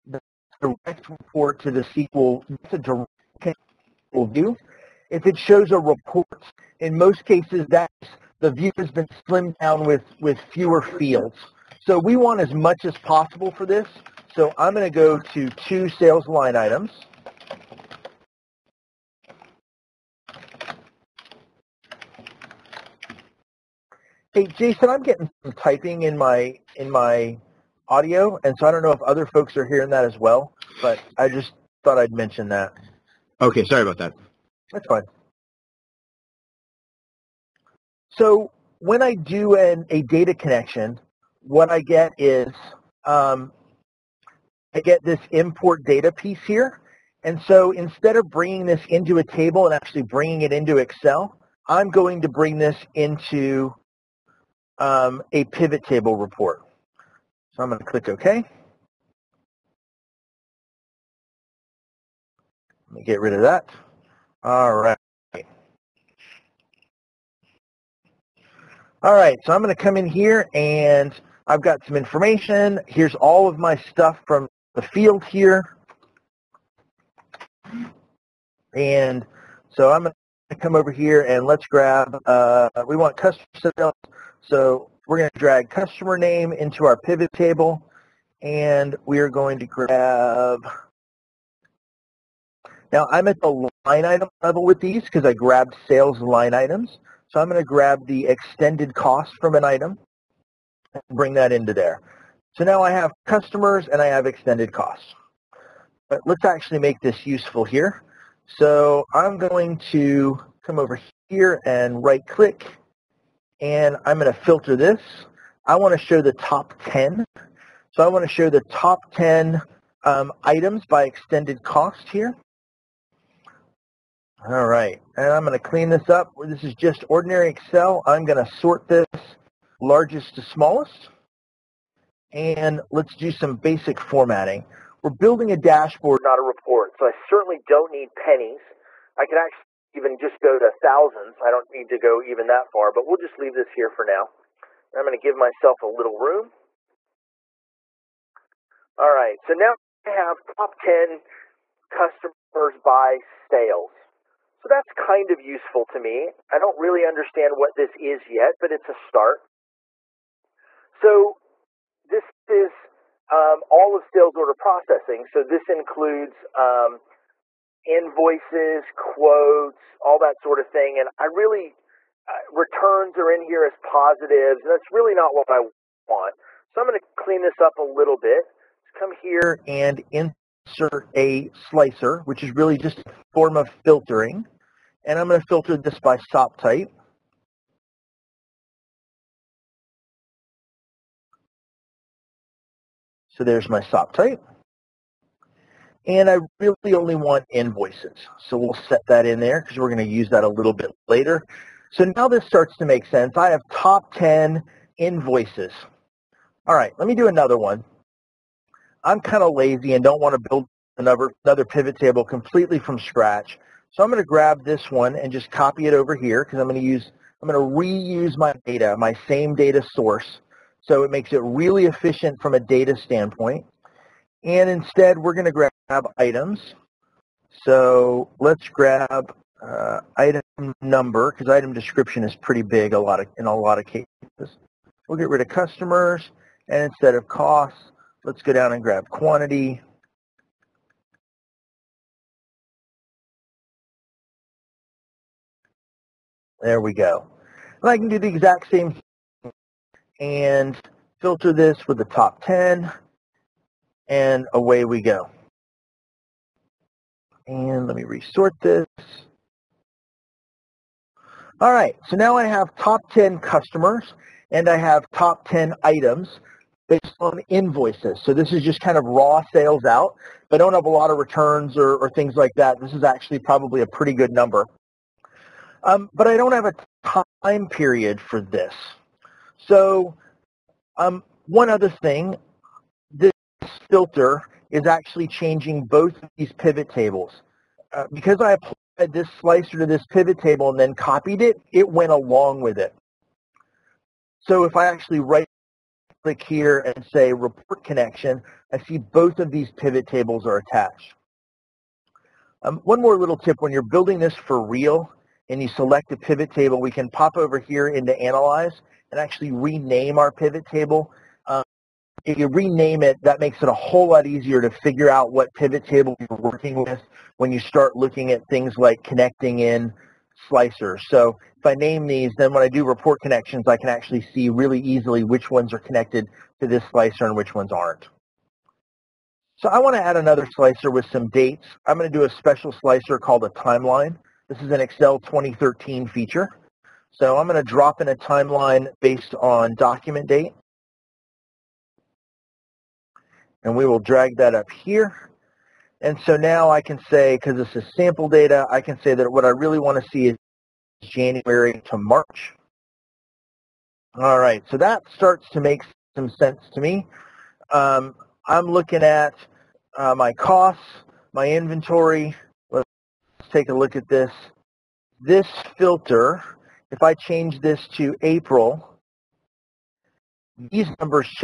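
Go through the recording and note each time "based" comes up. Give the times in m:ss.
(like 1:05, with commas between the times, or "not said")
4:26, 5:39.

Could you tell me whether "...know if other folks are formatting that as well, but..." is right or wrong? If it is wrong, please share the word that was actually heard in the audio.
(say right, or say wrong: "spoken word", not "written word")
wrong: "hearing", not "formatting".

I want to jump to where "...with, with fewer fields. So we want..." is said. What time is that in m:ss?
0:09.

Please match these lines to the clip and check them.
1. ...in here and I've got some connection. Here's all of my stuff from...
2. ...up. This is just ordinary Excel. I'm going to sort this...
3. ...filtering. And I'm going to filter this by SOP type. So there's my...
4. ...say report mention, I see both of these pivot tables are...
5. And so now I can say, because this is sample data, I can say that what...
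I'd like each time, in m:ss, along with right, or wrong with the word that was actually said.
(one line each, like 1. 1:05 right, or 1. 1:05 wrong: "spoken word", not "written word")
1. 1:09 wrong: "information", not "connection"
2. 2:06 right
3. 3:03 right
4. 4:57 wrong: "connection", not "mention"
5. 5:46 right.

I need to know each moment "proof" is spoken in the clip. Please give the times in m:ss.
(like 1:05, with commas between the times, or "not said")
not said.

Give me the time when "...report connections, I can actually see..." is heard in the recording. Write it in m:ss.
5:22.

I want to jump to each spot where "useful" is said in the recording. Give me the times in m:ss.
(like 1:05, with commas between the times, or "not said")
1:47, 2:35.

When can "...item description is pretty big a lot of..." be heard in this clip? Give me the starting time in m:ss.
3:51.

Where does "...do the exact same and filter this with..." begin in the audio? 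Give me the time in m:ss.
4:08.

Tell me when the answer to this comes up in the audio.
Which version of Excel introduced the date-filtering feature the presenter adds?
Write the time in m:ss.
5:34.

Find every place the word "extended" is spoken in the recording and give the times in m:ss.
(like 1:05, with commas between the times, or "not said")
1:38, 1:44, 2:01.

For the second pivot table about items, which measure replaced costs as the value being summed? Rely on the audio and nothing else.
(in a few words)
quantity.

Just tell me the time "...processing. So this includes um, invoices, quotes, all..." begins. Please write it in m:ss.
2:44.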